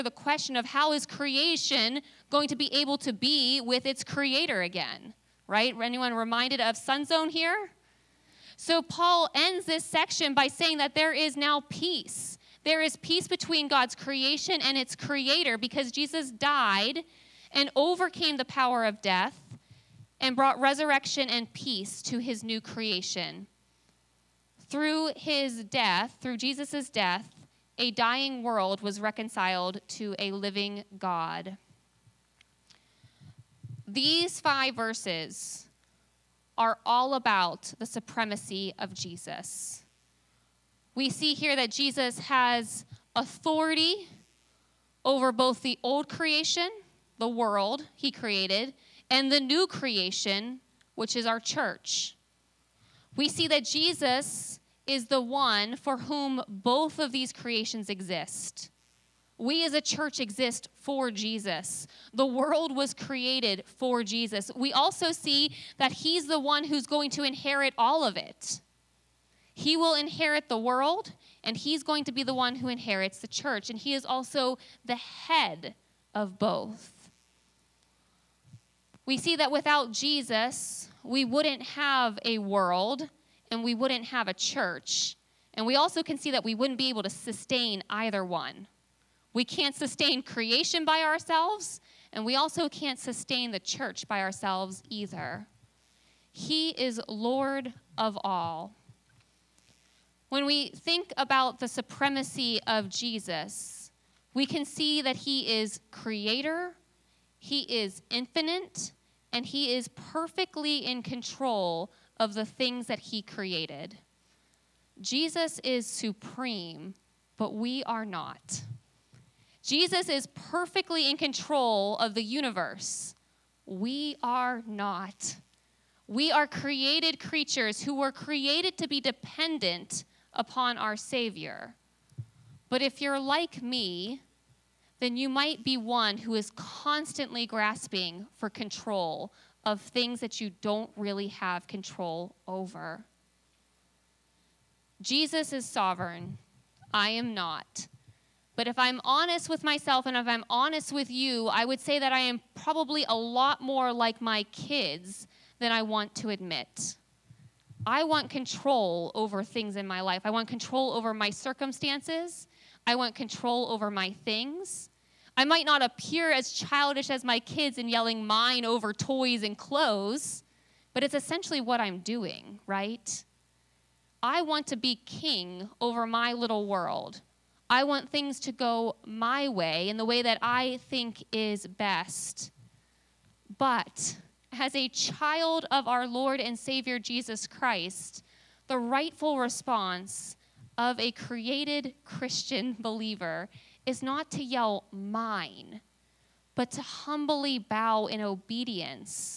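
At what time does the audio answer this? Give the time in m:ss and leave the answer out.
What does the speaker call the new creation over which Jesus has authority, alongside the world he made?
0:51.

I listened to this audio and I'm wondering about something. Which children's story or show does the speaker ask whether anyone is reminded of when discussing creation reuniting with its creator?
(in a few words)
Sun Zone.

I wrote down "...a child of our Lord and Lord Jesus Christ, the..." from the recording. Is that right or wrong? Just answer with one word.
wrong.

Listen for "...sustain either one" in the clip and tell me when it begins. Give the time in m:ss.
1:27.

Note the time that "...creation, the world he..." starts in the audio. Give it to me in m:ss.
0:46.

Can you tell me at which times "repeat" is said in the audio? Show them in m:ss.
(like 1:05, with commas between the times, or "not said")
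not said.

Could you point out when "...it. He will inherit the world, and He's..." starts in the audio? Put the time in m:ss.
1:08.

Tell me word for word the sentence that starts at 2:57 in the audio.
I want things to go my way in the way that I think is best.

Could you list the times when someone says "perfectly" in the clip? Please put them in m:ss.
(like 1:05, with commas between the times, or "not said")
1:49, 2:00.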